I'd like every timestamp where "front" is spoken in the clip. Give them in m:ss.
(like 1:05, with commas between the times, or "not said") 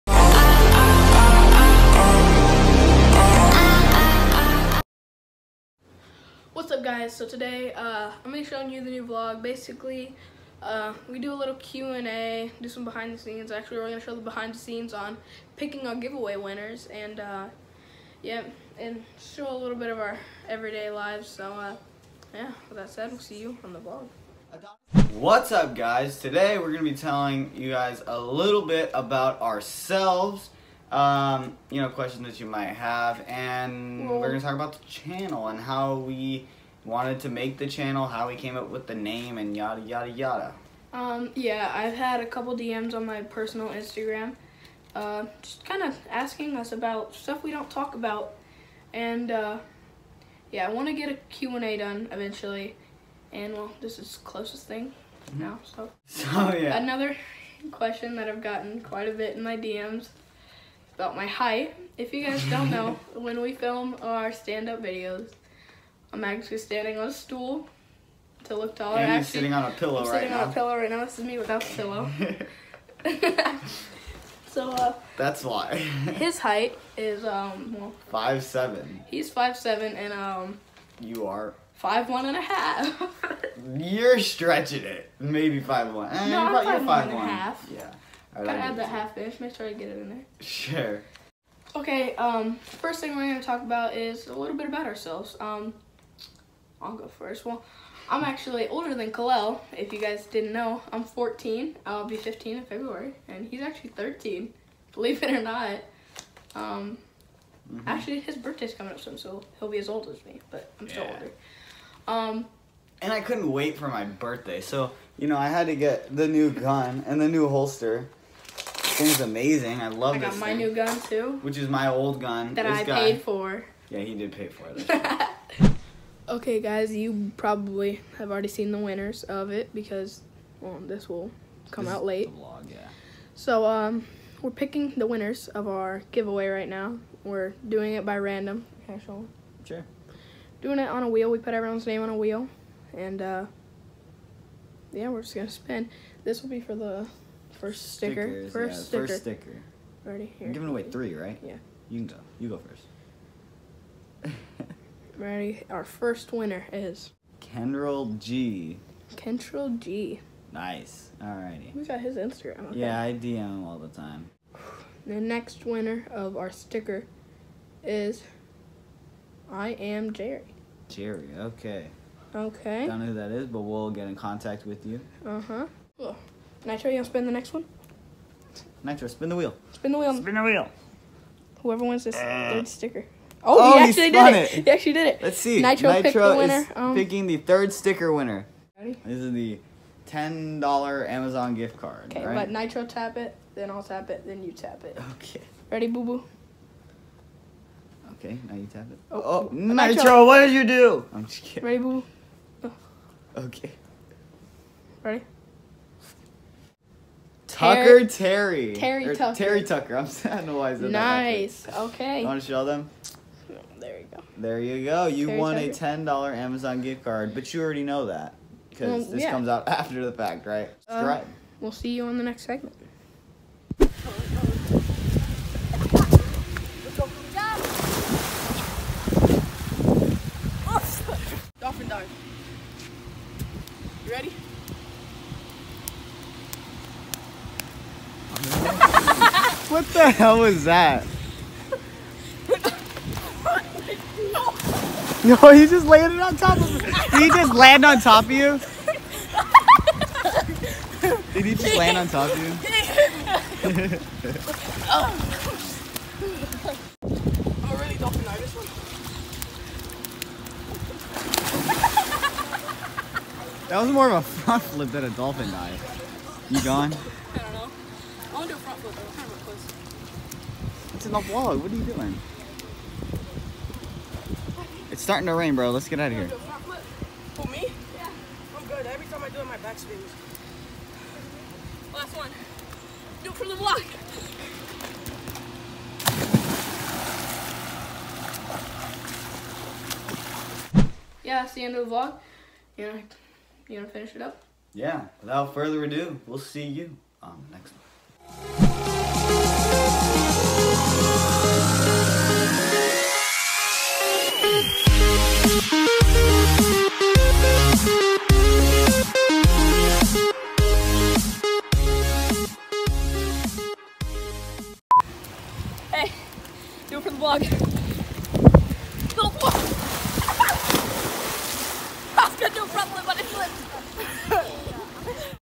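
4:24, 4:28, 5:22.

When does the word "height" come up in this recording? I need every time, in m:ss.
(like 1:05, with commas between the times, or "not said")
1:01, 1:16.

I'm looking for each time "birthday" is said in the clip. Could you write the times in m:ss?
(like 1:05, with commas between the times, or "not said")
1:48, 1:54.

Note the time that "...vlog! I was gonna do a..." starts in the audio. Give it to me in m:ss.
5:19.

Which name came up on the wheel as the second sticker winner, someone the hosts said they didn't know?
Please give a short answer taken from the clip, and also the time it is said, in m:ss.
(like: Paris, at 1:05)
I am Jerry, at 2:49.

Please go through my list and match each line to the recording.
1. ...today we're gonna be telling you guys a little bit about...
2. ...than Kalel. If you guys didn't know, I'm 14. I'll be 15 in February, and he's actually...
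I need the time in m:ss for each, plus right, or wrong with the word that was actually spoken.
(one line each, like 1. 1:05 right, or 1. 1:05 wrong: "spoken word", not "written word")
1. 0:26 right
2. 1:38 right.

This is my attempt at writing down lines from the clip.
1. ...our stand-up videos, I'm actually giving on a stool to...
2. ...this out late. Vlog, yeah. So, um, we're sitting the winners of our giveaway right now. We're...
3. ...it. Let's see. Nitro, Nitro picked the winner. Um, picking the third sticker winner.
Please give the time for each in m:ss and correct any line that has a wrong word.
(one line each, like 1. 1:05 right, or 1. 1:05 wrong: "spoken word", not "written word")
1. 1:04 wrong: "standing", not "giving"
2. 2:11 wrong: "picking", not "sitting"
3. 3:05 right.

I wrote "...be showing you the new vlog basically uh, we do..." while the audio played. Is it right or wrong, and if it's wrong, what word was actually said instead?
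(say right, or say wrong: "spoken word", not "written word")
right.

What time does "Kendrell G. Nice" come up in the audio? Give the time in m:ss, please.
2:39.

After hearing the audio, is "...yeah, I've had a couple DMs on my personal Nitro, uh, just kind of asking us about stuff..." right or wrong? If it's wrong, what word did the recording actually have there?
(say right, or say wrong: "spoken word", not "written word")
wrong: "Instagram", not "Nitro".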